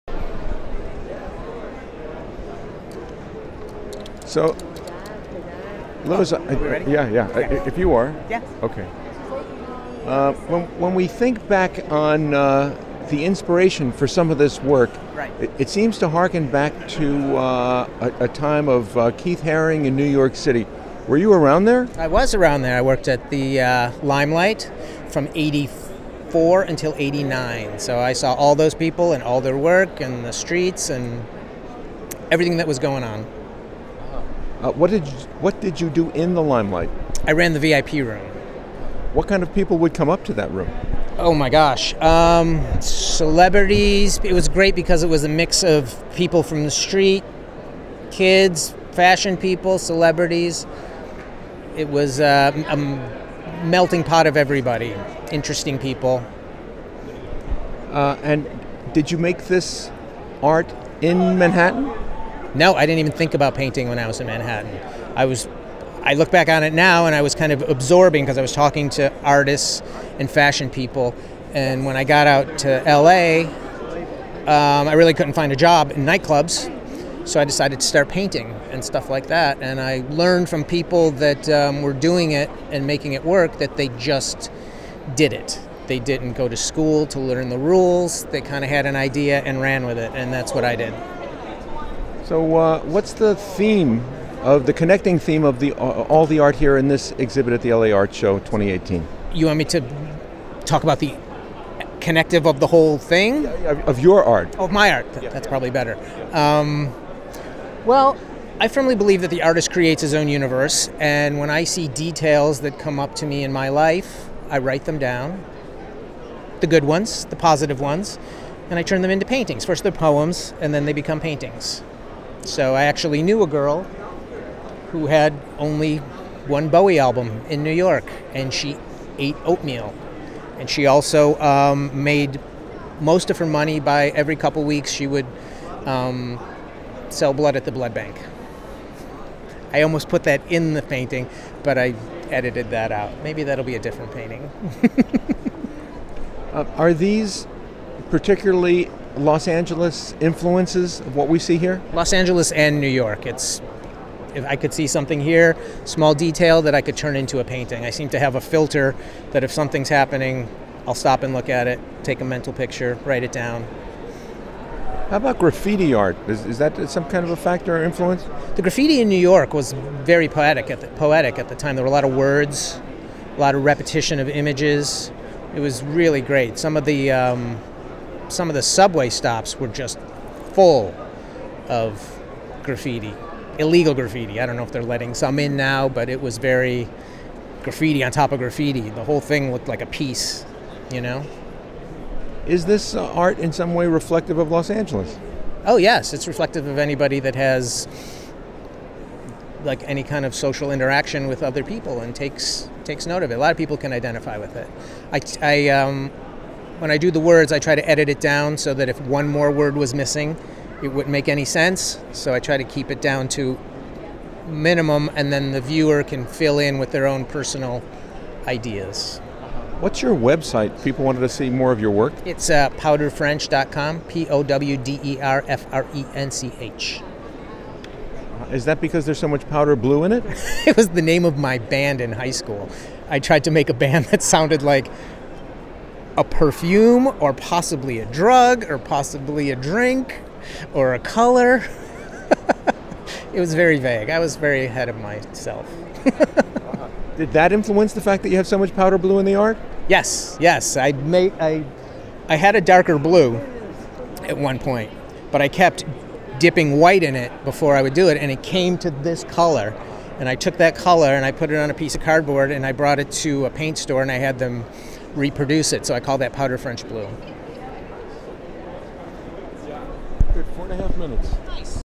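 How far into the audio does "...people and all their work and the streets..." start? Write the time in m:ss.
0:28.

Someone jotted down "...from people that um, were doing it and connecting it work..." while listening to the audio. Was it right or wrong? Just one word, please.
wrong.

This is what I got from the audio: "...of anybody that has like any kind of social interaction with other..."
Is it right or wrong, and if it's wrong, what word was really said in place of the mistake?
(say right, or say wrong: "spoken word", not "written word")
right.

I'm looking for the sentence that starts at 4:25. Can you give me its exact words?
So I call that powder French blue.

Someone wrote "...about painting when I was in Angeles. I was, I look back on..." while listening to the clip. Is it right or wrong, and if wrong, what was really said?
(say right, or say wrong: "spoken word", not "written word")
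wrong: "Manhattan", not "Angeles".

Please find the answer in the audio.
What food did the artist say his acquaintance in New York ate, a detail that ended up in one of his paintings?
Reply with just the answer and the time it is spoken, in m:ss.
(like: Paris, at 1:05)
Oatmeal, at 2:09.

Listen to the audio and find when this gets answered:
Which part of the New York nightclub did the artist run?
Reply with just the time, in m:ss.
0:37.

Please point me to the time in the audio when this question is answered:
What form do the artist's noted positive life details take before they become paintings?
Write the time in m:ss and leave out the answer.
1:59.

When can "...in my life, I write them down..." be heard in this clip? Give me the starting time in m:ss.
1:53.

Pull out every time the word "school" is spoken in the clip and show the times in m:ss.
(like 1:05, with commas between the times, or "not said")
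1:26, 3:52.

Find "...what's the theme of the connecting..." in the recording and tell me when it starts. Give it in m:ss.
1:32.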